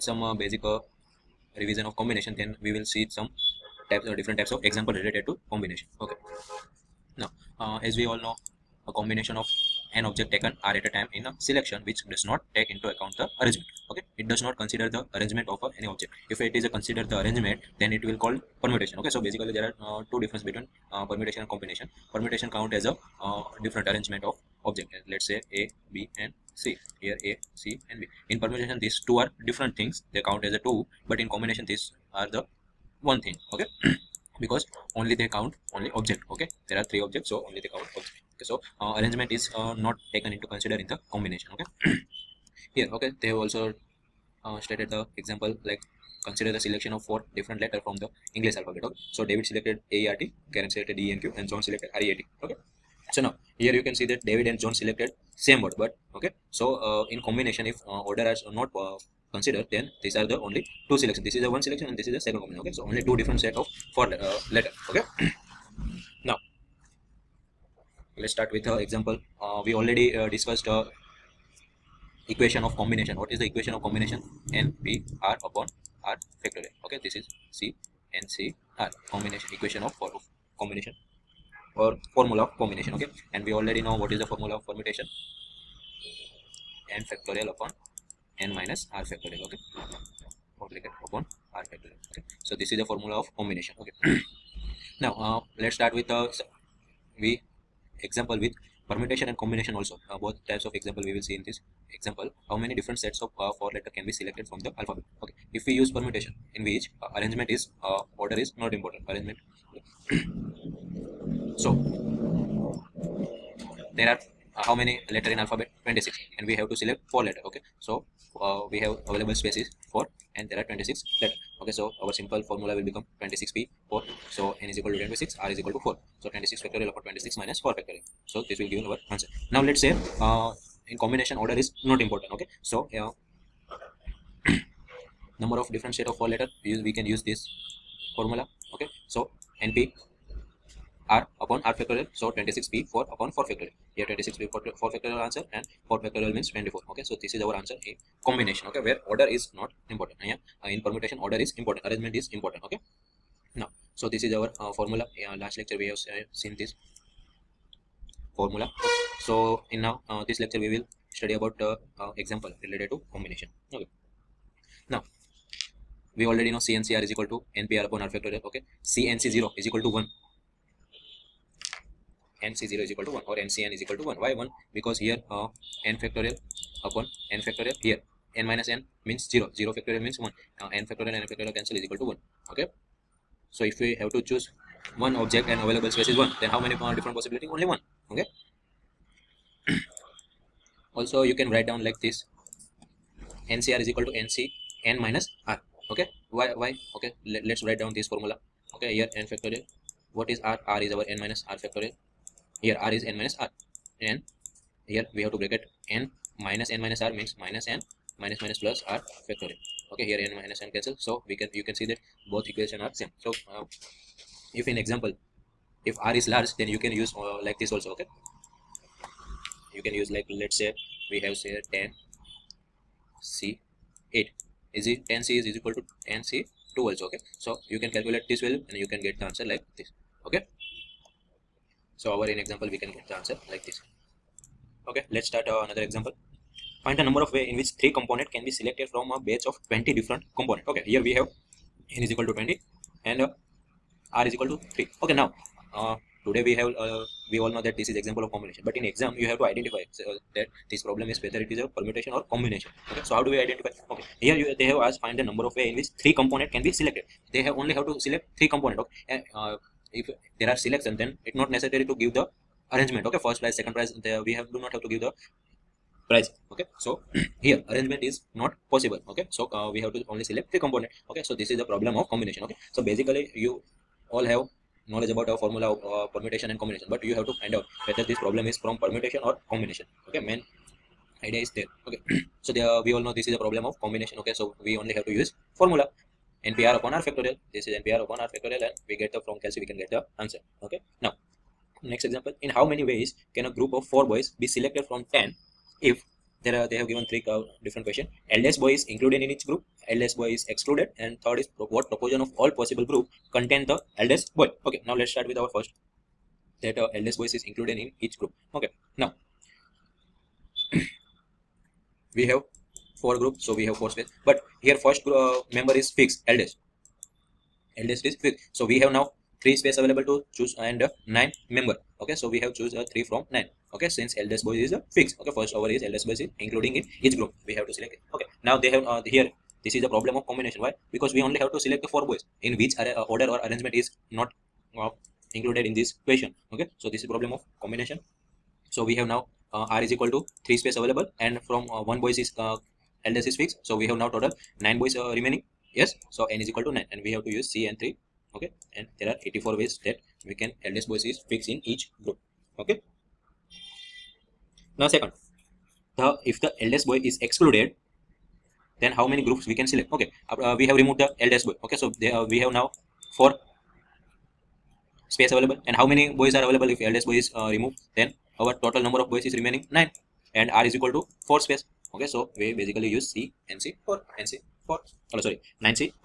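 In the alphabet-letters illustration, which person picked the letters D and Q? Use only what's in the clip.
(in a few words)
Karen.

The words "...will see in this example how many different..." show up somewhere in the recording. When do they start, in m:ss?
1:41.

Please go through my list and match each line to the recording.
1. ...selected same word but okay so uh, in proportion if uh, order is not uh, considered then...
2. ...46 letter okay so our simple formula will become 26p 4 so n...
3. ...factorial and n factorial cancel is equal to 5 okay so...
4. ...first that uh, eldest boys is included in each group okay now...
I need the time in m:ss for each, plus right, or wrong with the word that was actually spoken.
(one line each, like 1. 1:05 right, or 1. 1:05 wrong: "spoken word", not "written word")
1. 0:54 wrong: "combination", not "proportion"
2. 2:00 wrong: "26", not "46"
3. 3:00 wrong: "1", not "5"
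4. 5:05 right.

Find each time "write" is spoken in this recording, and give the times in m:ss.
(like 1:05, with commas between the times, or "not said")
3:11, 3:17.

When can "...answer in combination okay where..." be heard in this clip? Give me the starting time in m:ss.
2:27.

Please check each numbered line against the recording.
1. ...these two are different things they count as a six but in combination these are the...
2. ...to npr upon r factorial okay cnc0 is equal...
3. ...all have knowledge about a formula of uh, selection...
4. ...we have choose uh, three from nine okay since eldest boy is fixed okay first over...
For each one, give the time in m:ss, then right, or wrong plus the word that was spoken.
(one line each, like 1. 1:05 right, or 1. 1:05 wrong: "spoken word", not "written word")
1. 0:28 wrong: "two", not "six"
2. 2:47 right
3. 4:34 wrong: "permutation", not "selection"
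4. 5:22 right.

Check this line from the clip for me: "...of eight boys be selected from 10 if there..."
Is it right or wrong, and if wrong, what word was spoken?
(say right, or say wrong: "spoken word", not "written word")
wrong: "four", not "eight".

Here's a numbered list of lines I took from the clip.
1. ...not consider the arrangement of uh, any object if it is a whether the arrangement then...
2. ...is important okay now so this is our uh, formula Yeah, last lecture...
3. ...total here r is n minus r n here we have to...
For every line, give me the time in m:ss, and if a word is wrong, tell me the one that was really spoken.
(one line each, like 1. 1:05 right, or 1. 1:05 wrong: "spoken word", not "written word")
1. 0:14 wrong: "consider", not "whether"
2. 2:32 right
3. 3:21 wrong: "factorial", not "total".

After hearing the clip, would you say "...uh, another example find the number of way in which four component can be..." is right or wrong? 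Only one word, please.
wrong.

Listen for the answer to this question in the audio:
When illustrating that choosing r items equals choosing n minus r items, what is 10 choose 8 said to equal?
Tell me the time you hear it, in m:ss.
3:45.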